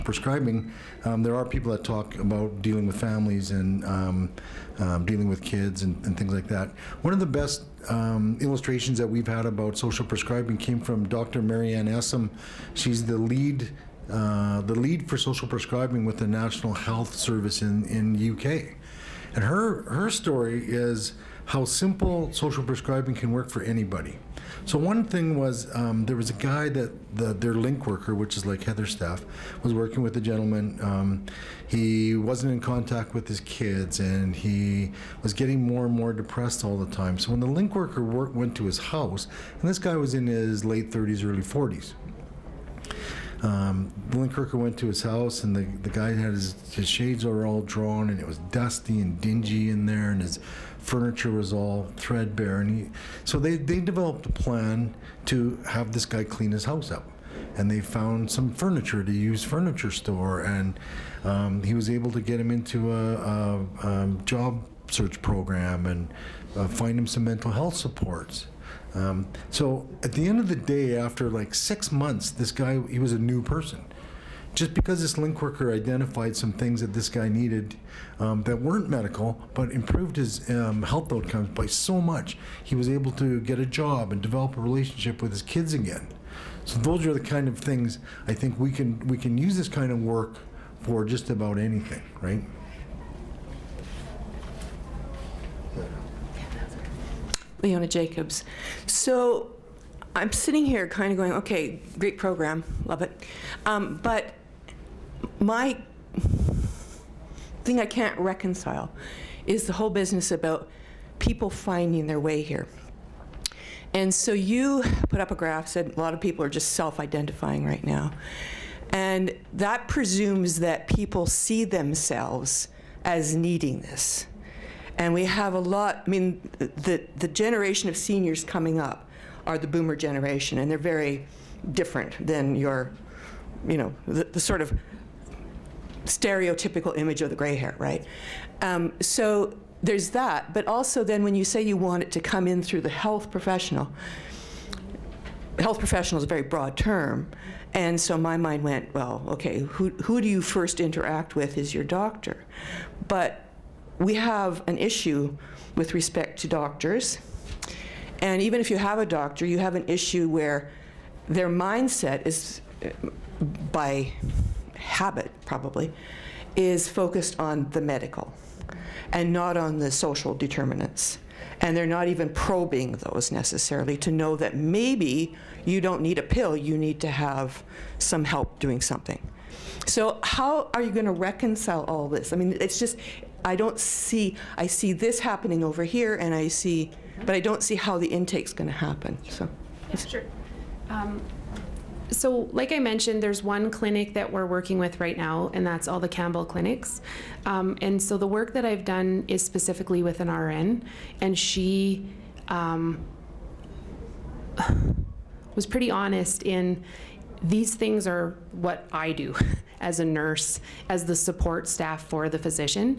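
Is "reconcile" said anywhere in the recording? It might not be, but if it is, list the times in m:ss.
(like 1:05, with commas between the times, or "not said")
1:48, 3:01.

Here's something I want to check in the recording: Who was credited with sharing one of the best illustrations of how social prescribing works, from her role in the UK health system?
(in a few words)
Dr. Marie Anne Essam.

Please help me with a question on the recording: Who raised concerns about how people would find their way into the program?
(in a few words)
Leona Jacobs.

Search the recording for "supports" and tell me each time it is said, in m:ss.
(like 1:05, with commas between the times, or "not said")
1:07, 3:31.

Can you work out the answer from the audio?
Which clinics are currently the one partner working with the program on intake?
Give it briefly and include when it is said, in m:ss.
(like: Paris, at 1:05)
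Campbell clinics, at 3:16.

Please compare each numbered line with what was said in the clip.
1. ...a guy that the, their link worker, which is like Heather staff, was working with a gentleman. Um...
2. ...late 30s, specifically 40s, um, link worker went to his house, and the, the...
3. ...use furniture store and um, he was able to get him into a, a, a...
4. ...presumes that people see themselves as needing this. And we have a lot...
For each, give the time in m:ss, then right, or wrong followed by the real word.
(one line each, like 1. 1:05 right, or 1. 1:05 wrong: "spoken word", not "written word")
1. 0:26 right
2. 0:40 wrong: "early", not "specifically"
3. 0:59 right
4. 1:59 right.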